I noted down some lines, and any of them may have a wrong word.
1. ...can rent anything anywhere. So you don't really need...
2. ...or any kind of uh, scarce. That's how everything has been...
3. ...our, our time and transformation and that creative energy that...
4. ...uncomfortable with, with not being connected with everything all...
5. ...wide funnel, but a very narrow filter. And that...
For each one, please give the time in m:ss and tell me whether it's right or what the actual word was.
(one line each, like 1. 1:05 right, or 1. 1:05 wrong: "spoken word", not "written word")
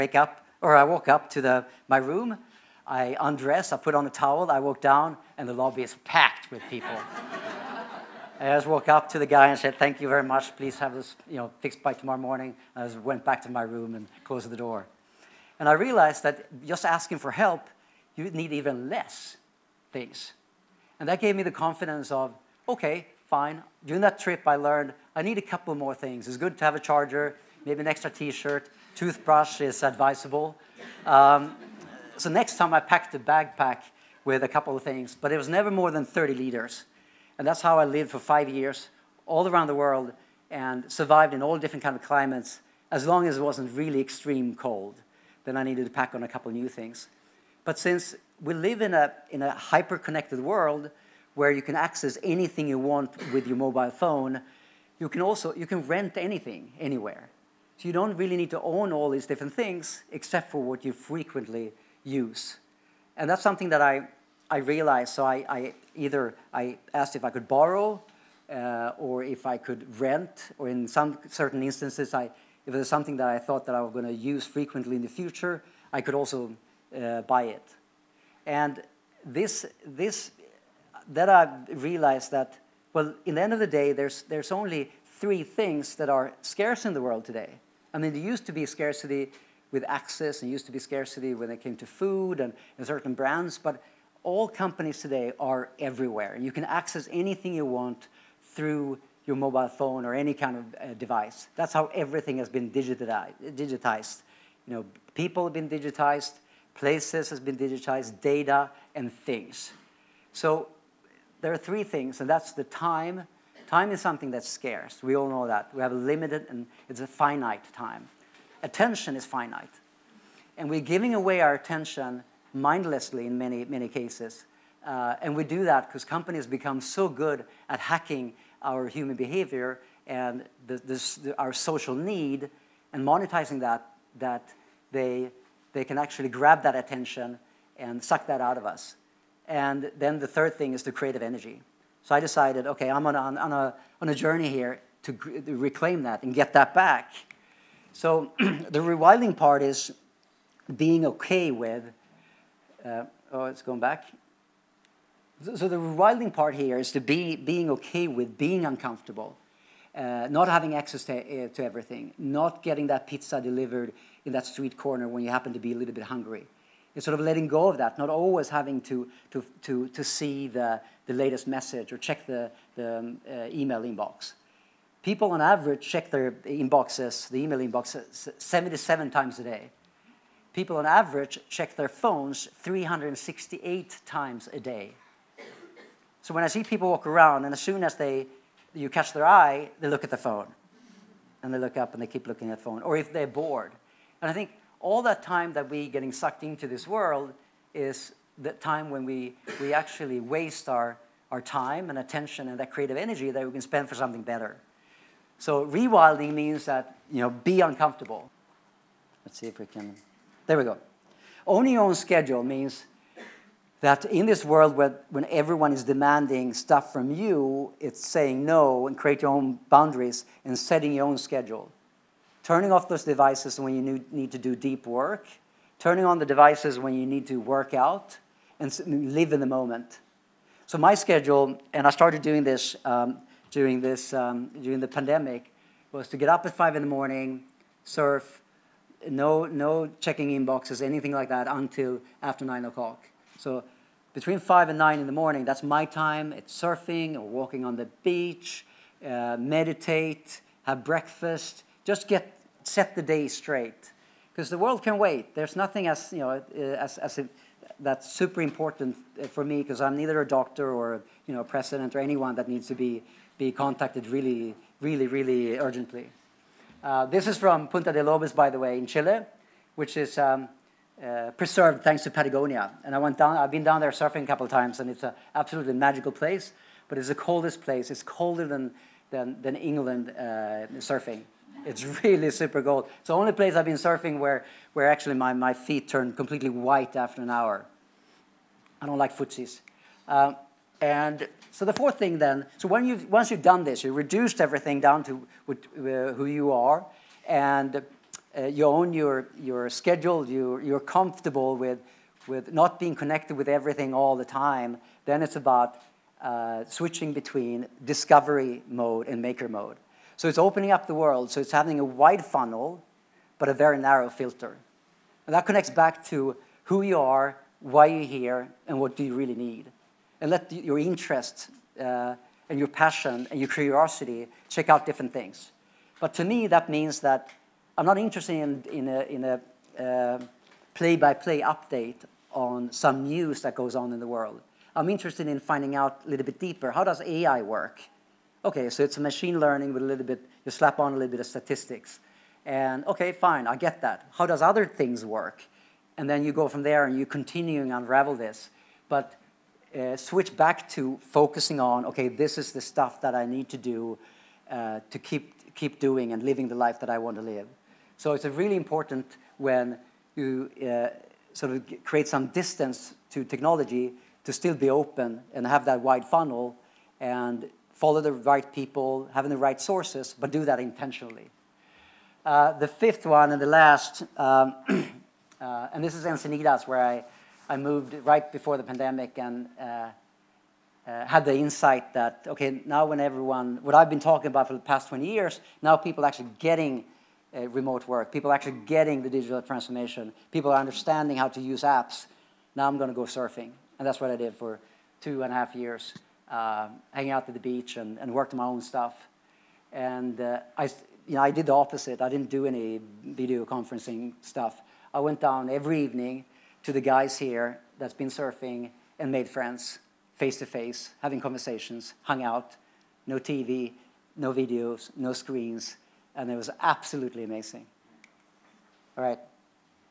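1. 0:55 right
2. 1:40 wrong: "device", not "scarce"
3. 3:20 wrong: "attention", not "transformation"
4. 5:00 wrong: "comfortable", not "uncomfortable"
5. 5:11 right.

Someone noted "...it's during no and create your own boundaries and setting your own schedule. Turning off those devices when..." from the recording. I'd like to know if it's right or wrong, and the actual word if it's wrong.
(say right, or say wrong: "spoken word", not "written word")
wrong: "saying", not "during".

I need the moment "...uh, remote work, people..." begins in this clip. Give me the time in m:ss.
6:27.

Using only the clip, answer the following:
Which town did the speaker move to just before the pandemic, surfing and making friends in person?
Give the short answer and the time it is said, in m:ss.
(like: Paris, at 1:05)
Encinitas, at 6:16.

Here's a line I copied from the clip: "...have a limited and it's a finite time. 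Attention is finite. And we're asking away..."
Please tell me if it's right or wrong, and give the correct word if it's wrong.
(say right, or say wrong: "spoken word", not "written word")
wrong: "giving", not "asking".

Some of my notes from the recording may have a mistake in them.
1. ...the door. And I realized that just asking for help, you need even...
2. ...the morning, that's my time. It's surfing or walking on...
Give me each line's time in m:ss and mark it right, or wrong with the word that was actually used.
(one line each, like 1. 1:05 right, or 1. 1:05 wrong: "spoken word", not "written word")
1. 0:14 right
2. 4:05 right.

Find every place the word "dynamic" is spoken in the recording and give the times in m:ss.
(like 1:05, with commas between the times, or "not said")
not said.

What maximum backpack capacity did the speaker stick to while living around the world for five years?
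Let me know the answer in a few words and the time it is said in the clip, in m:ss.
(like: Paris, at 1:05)
30 liters, at 0:36.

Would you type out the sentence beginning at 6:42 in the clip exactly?
I didn't do any video conferencing stuff.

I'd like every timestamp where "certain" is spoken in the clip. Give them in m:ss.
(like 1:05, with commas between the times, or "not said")
1:11, 1:32.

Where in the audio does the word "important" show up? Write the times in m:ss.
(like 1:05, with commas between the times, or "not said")
4:18, 5:58.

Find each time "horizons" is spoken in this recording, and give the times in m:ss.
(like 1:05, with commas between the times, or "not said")
not said.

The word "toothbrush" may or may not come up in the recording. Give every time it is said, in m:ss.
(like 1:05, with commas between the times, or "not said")
0:28.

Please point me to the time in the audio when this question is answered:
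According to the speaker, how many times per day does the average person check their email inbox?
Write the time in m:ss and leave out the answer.
2:58.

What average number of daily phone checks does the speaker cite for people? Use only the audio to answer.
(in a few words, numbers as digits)
368.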